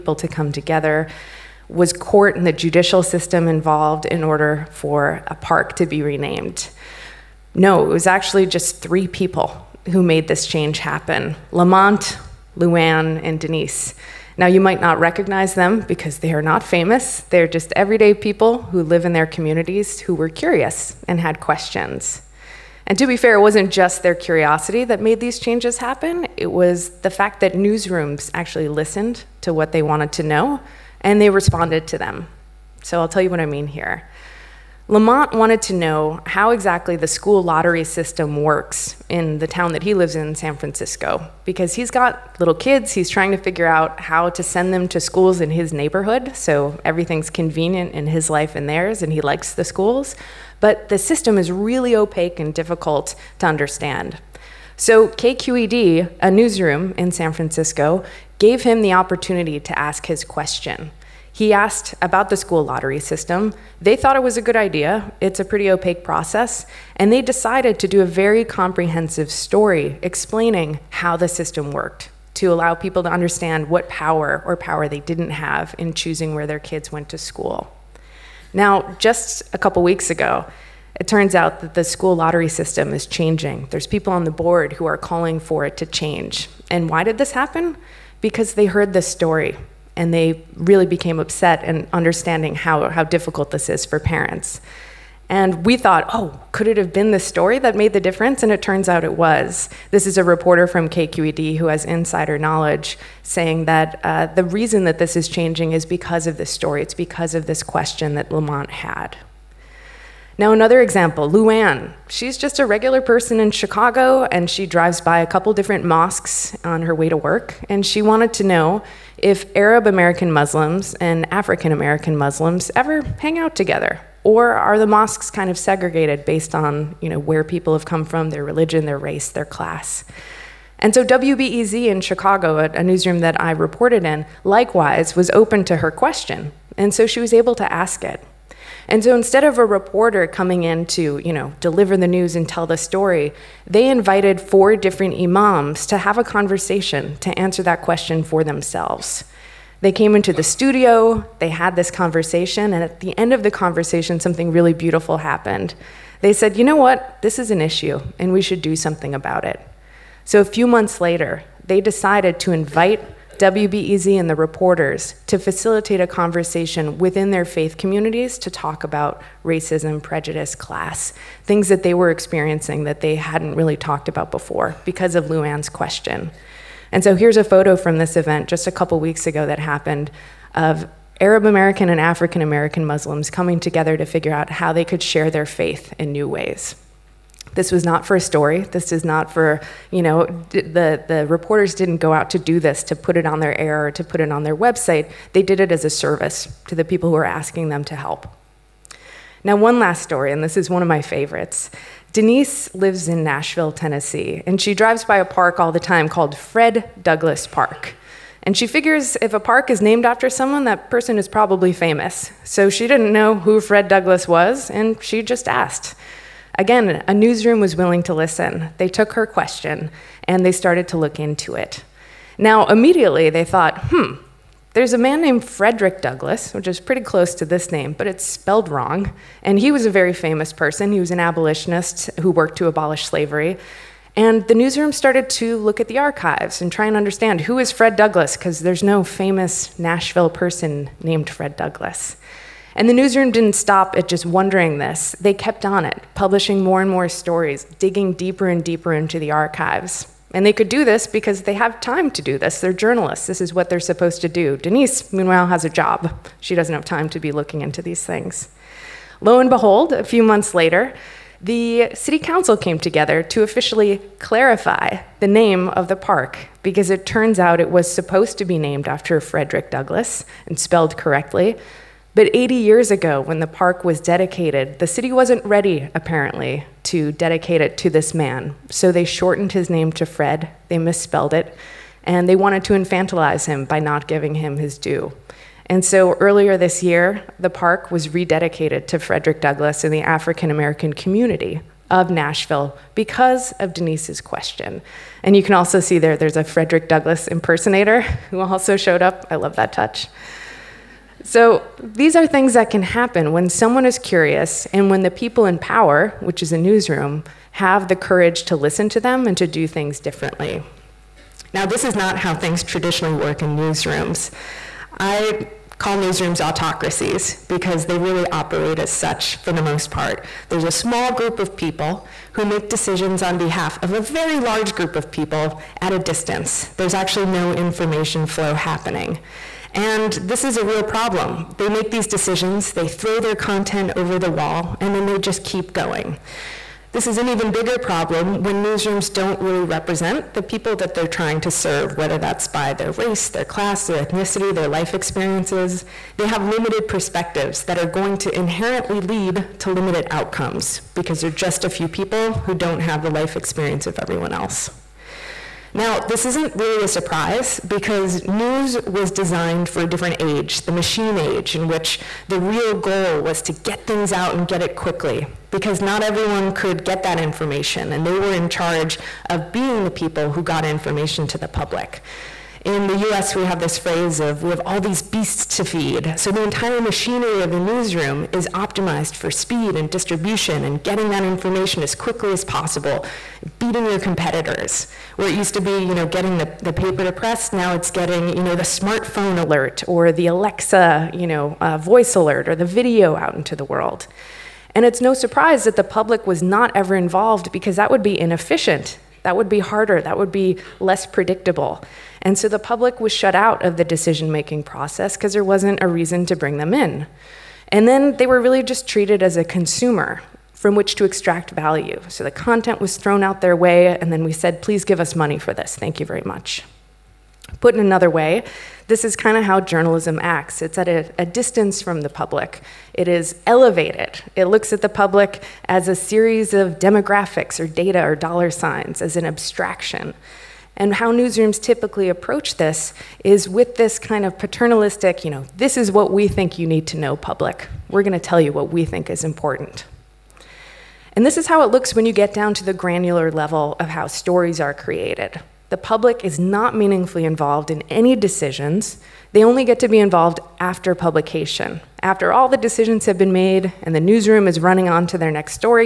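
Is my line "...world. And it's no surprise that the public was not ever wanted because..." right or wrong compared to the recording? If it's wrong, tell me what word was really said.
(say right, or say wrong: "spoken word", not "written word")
wrong: "involved", not "wanted".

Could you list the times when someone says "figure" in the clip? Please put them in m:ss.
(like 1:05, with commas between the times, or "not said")
0:43, 3:04, 3:28.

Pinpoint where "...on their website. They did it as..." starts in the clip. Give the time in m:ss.
3:14.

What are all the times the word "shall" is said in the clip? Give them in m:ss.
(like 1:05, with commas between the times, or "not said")
not said.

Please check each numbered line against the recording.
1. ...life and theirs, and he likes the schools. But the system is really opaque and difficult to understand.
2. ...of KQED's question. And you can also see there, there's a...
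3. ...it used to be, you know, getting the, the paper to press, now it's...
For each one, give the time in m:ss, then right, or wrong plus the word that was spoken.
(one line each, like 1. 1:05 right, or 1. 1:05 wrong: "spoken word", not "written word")
1. 0:48 right
2. 4:53 wrong: "Denise", not "KQED"
3. 6:25 right.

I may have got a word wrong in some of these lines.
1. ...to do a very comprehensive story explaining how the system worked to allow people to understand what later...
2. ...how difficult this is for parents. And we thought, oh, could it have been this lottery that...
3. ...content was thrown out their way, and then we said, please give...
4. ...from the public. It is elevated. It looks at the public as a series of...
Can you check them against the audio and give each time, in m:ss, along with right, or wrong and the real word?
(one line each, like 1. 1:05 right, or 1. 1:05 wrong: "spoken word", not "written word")
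1. 1:07 wrong: "power", not "later"
2. 1:32 wrong: "story", not "lottery"
3. 6:52 right
4. 7:01 right.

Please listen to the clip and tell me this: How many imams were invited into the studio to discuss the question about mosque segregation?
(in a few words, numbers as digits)
4.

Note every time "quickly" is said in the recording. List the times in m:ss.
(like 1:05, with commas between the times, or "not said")
6:04, 6:21.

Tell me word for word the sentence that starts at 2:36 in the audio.
They said, you know what, this is an issue, and we should do something about it.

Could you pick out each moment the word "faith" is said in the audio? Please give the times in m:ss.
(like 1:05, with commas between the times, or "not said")
2:47, 3:05.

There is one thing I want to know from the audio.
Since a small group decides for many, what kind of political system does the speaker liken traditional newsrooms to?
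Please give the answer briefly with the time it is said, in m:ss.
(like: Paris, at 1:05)
Autocracies, at 5:16.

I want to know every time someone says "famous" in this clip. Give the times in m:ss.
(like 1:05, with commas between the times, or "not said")
0:16, 3:31, 3:50, 3:59.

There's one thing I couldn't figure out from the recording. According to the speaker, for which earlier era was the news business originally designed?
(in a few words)
The machine age.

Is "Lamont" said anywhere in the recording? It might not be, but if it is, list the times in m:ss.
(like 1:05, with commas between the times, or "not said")
0:11, 0:34, 1:48.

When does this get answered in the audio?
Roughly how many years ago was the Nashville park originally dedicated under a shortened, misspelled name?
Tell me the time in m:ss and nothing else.
4:32.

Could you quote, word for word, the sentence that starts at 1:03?
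They thought it was a good idea.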